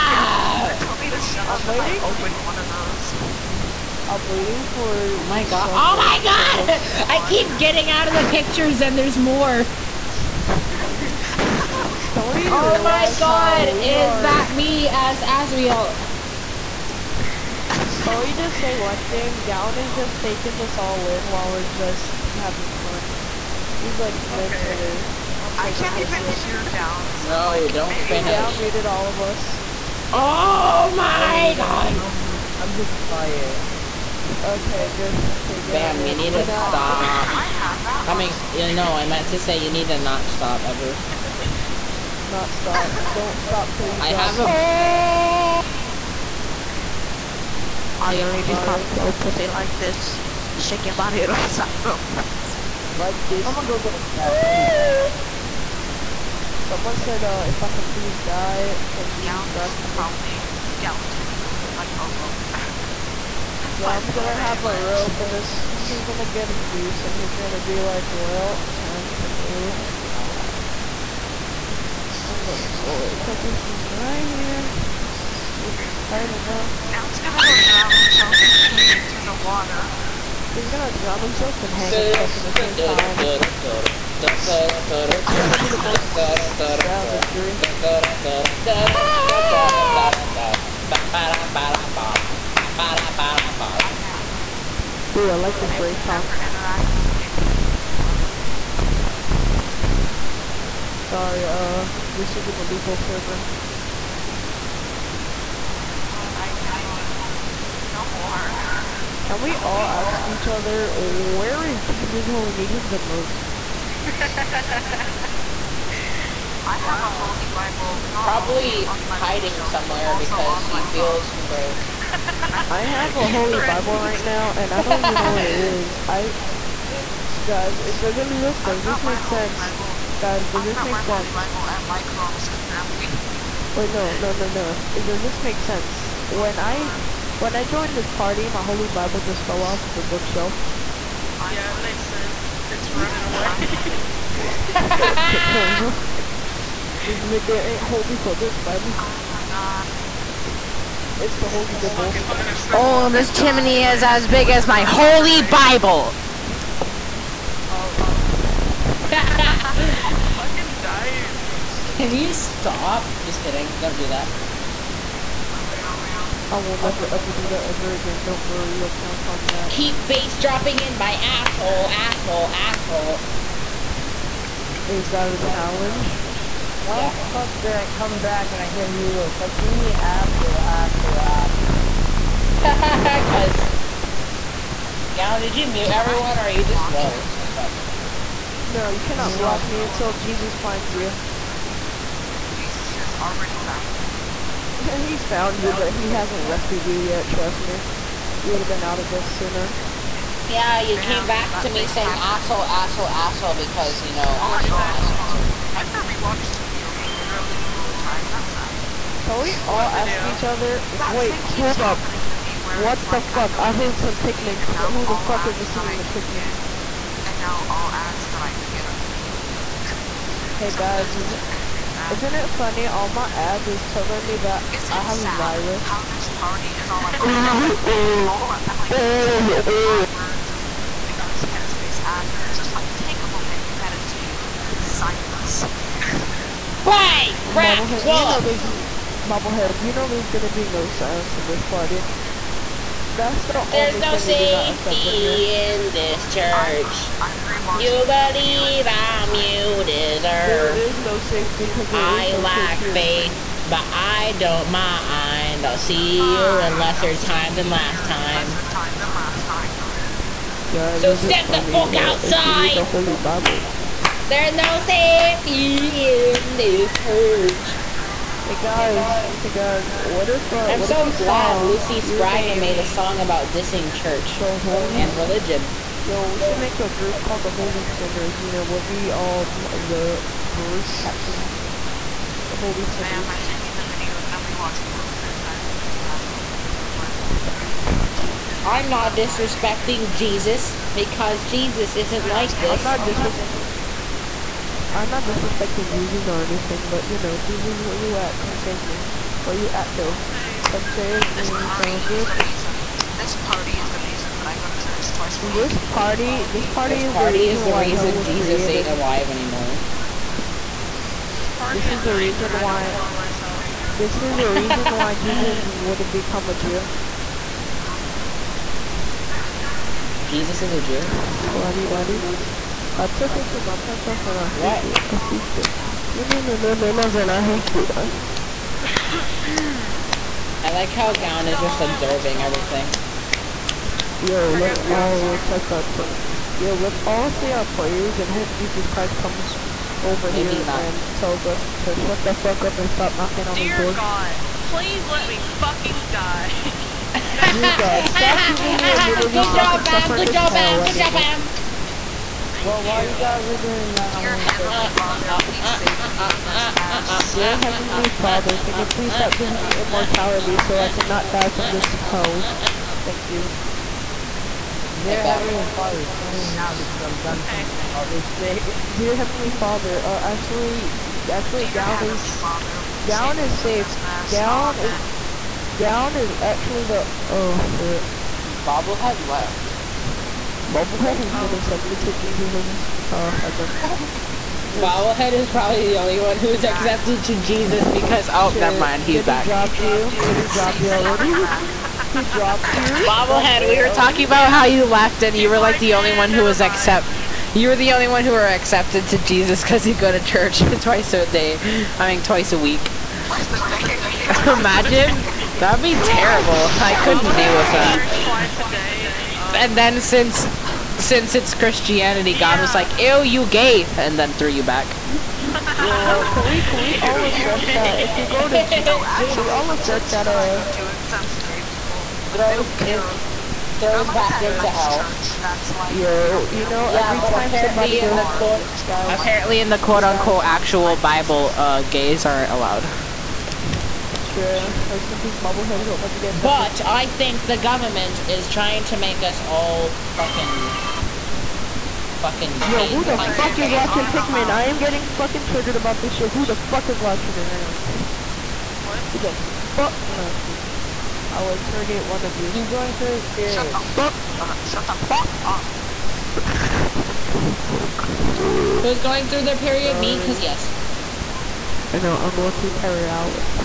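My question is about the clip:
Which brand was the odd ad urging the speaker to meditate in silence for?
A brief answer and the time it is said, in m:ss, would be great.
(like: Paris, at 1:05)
Headspace, at 3:51.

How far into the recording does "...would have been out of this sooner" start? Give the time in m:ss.
3:18.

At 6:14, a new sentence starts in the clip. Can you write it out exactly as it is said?
Gown is gown is actually the oh shit.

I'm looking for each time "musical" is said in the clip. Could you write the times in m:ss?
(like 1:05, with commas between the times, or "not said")
3:39.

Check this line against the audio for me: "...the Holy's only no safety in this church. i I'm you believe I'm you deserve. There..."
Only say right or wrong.
wrong.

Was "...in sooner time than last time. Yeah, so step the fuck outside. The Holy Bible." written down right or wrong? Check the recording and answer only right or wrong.
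wrong.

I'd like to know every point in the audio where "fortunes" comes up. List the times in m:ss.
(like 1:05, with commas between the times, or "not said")
not said.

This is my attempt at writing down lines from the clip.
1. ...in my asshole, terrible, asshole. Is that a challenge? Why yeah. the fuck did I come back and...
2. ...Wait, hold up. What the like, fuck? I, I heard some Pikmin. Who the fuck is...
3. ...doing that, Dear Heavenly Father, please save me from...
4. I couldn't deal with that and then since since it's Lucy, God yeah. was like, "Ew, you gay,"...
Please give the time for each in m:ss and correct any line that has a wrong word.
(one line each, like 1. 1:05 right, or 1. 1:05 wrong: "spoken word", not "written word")
1. 2:50 wrong: "asshole", not "terrible"
2. 3:31 right
3. 5:53 right
4. 6:46 wrong: "Christianity", not "Lucy".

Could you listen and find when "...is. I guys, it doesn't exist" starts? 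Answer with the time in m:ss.
2:05.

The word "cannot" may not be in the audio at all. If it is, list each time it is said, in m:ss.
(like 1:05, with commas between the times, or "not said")
1:46, 3:08, 6:00.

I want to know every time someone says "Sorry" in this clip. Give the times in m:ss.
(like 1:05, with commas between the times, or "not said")
1:41, 7:39.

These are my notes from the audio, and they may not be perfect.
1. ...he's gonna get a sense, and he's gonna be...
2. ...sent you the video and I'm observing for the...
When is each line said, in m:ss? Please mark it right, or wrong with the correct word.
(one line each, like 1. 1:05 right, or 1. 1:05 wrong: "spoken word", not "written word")
1. 1:05 wrong: "noose", not "sense"
2. 4:43 wrong: "rewatching", not "observing".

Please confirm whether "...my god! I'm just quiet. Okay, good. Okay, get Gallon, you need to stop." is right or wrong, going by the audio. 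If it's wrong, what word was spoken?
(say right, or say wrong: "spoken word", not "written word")
wrong: "Bam", not "Gallon".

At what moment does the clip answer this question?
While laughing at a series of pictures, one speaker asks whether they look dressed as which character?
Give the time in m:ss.
0:15.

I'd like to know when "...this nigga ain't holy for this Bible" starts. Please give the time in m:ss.
2:27.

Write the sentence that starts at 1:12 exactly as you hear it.
I'm gonna slowly put this right here.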